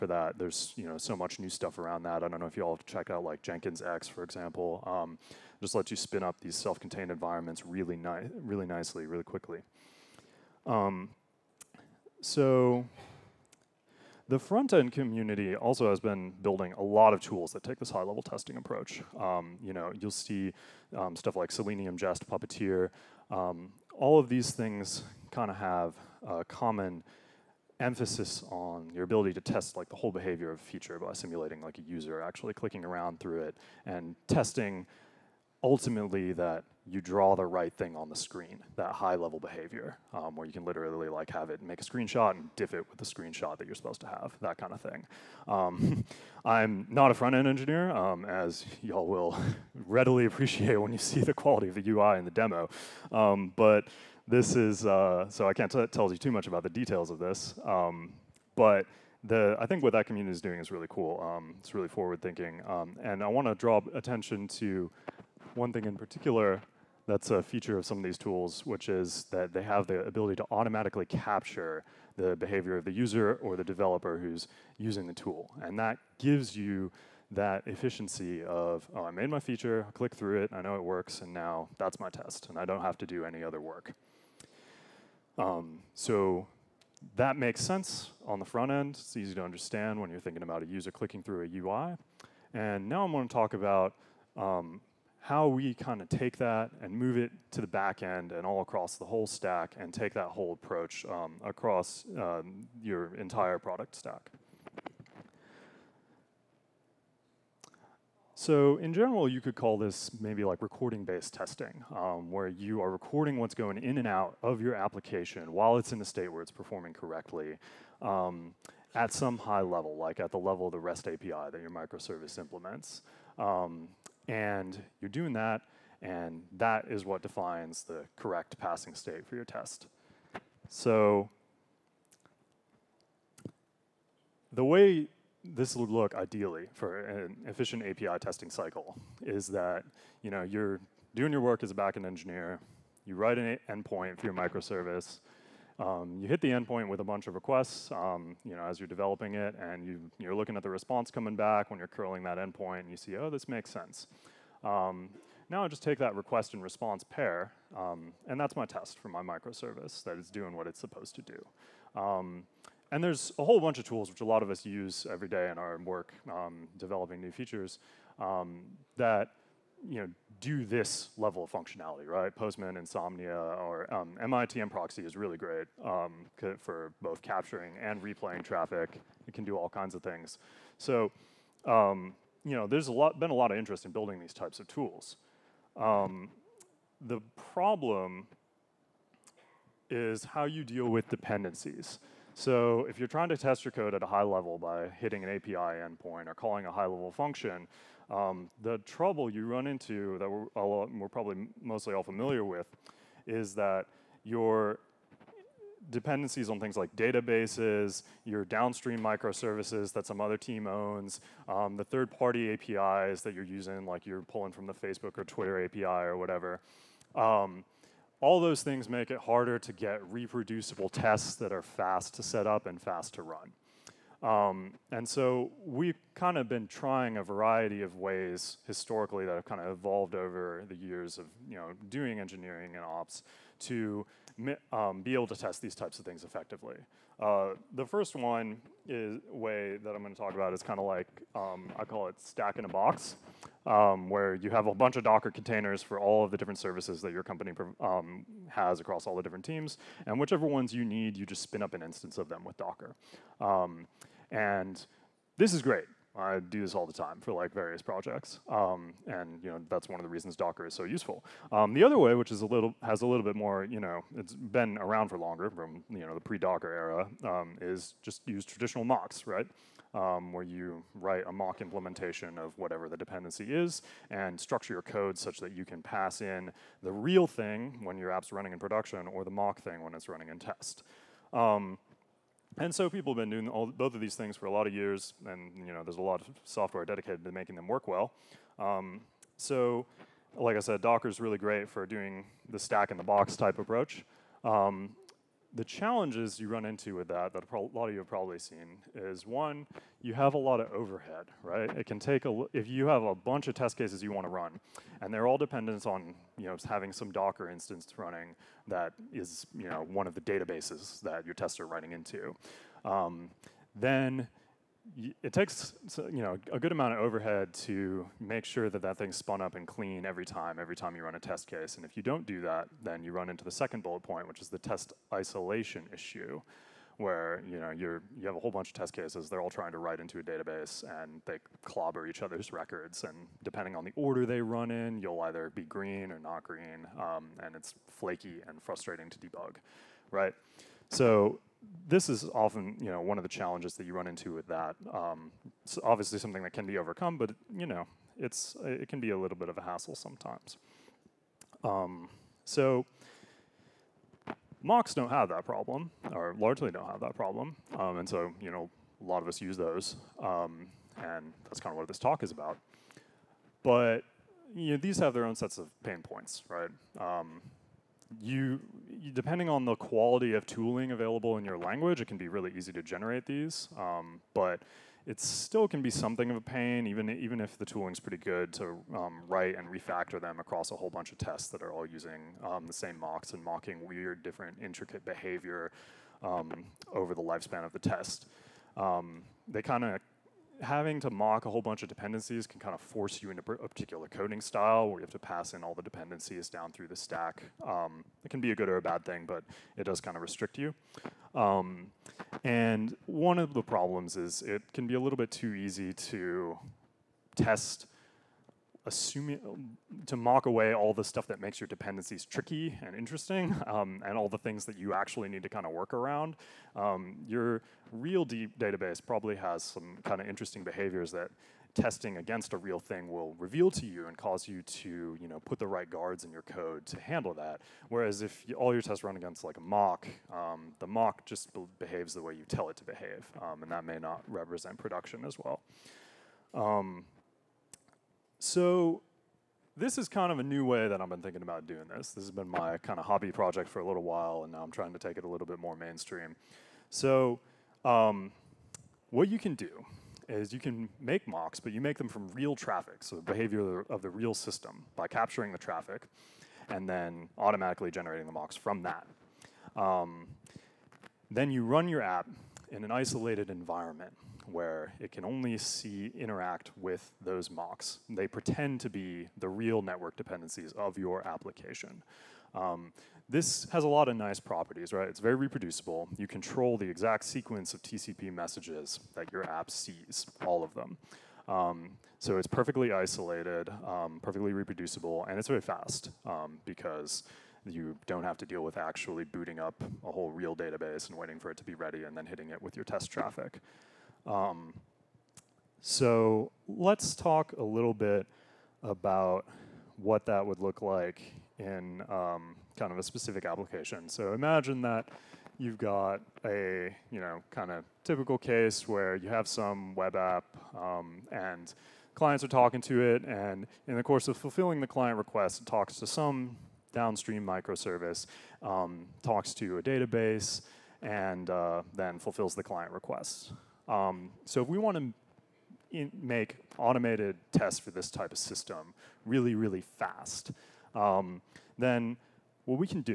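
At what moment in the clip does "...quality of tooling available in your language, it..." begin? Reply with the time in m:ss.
6:09.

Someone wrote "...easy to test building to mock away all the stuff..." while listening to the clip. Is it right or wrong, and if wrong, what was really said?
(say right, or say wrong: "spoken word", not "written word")
wrong: "assuming", not "building".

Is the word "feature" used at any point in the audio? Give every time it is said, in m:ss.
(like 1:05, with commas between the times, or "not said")
0:30, 1:07, 1:19, 2:47.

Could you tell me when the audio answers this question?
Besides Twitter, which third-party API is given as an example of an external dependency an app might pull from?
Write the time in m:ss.
3:34.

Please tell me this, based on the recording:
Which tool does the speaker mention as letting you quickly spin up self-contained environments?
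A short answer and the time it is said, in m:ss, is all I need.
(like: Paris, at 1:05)
Jenkins X, at 0:03.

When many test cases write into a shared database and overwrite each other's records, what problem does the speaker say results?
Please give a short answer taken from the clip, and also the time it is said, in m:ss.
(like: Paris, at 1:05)
test isolation issue, at 5:24.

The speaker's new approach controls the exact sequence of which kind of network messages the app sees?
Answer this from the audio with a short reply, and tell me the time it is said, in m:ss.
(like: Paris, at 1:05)
TCP messages, at 7:57.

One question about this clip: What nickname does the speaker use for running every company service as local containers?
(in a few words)
stack in a box.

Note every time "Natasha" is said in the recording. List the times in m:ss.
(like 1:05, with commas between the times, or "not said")
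not said.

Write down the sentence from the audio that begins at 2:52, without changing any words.
Postman, Insomnia, or um, MITM proxy is really great um, for both capturing and replaying traffic.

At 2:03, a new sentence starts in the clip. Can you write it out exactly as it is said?
Um, and you're doing that, and that is what defines the correct passing state for your test.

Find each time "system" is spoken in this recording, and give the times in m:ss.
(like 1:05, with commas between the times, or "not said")
7:34, 8:48.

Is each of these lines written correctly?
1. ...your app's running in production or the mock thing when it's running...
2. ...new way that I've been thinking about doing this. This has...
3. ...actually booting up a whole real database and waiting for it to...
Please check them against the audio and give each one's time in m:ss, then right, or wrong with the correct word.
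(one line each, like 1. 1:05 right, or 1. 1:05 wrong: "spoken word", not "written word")
1. 4:37 right
2. 7:20 right
3. 8:08 right.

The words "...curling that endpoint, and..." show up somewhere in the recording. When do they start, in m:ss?
2:31.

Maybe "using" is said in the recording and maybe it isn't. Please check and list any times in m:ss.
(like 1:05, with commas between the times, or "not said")
1:14, 3:33, 6:21.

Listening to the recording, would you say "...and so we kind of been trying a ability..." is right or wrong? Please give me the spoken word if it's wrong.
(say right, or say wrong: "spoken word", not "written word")
wrong: "variety", not "ability".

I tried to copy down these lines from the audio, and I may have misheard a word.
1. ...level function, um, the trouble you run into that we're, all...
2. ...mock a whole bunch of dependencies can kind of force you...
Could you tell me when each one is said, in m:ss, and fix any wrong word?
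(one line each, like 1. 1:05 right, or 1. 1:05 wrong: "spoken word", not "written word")
1. 3:16 right
2. 6:31 right.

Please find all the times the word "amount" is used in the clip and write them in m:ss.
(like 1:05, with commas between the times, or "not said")
5:16.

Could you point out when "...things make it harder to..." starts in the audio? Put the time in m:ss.
3:38.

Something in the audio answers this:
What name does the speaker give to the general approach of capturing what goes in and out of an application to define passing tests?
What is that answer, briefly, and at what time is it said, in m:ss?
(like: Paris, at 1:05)
recording-based testing, at 1:50.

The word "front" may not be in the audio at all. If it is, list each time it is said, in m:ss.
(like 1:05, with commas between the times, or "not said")
0:14, 0:47, 1:28.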